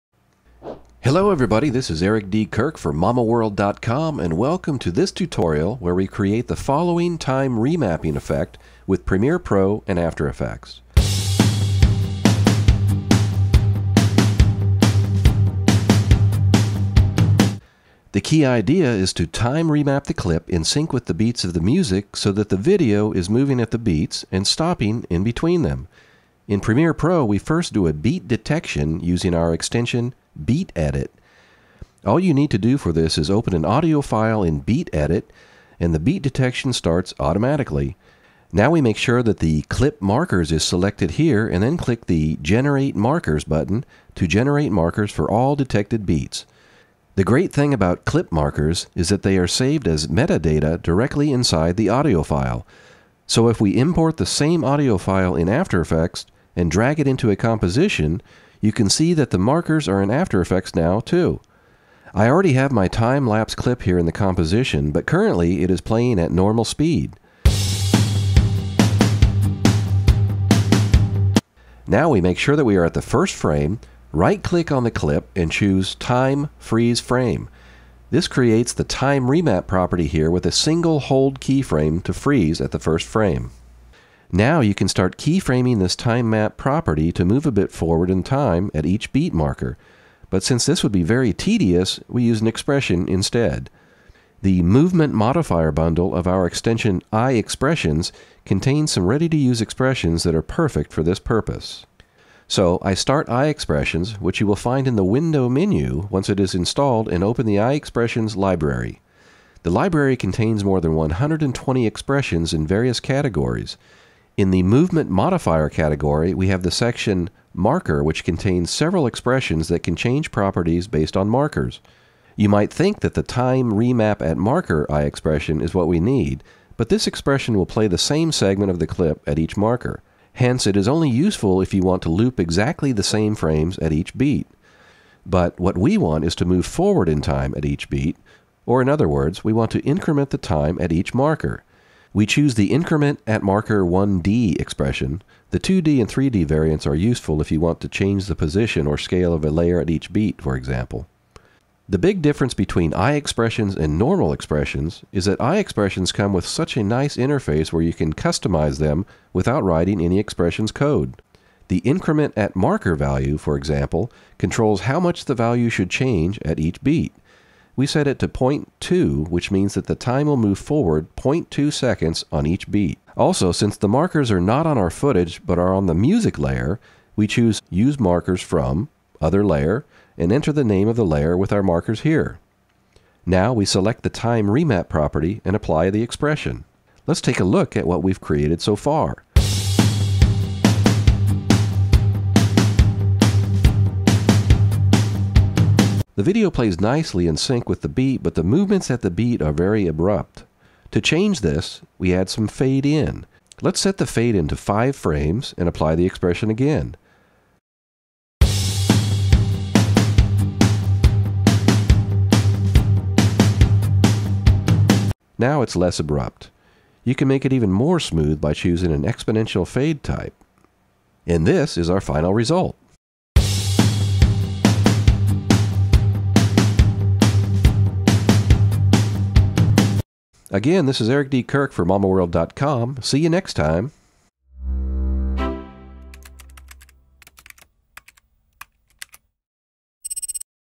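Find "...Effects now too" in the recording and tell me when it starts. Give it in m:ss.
1:00.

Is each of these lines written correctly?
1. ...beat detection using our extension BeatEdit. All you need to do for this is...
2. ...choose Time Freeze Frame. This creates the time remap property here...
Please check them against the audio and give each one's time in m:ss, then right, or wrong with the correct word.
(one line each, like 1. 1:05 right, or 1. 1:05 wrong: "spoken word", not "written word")
1. 0:27 right
2. 1:15 right.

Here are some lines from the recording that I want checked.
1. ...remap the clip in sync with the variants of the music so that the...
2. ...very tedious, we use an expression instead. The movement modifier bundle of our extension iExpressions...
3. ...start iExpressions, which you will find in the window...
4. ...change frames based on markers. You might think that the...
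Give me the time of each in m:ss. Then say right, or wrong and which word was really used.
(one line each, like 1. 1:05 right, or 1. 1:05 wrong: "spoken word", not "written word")
1. 0:19 wrong: "beats", not "variants"
2. 1:31 right
3. 1:42 right
4. 1:59 wrong: "properties", not "frames".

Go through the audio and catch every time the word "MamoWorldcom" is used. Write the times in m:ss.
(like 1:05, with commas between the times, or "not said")
0:02, 3:51.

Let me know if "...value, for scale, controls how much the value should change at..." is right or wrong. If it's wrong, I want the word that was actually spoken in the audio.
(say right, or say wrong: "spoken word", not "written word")
wrong: "example", not "scale".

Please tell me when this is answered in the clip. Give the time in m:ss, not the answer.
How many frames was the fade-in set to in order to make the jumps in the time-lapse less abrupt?
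3:24.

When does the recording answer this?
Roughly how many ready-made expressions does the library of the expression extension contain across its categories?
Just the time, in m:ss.
1:50.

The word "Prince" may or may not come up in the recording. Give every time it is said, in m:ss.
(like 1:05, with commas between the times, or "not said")
not said.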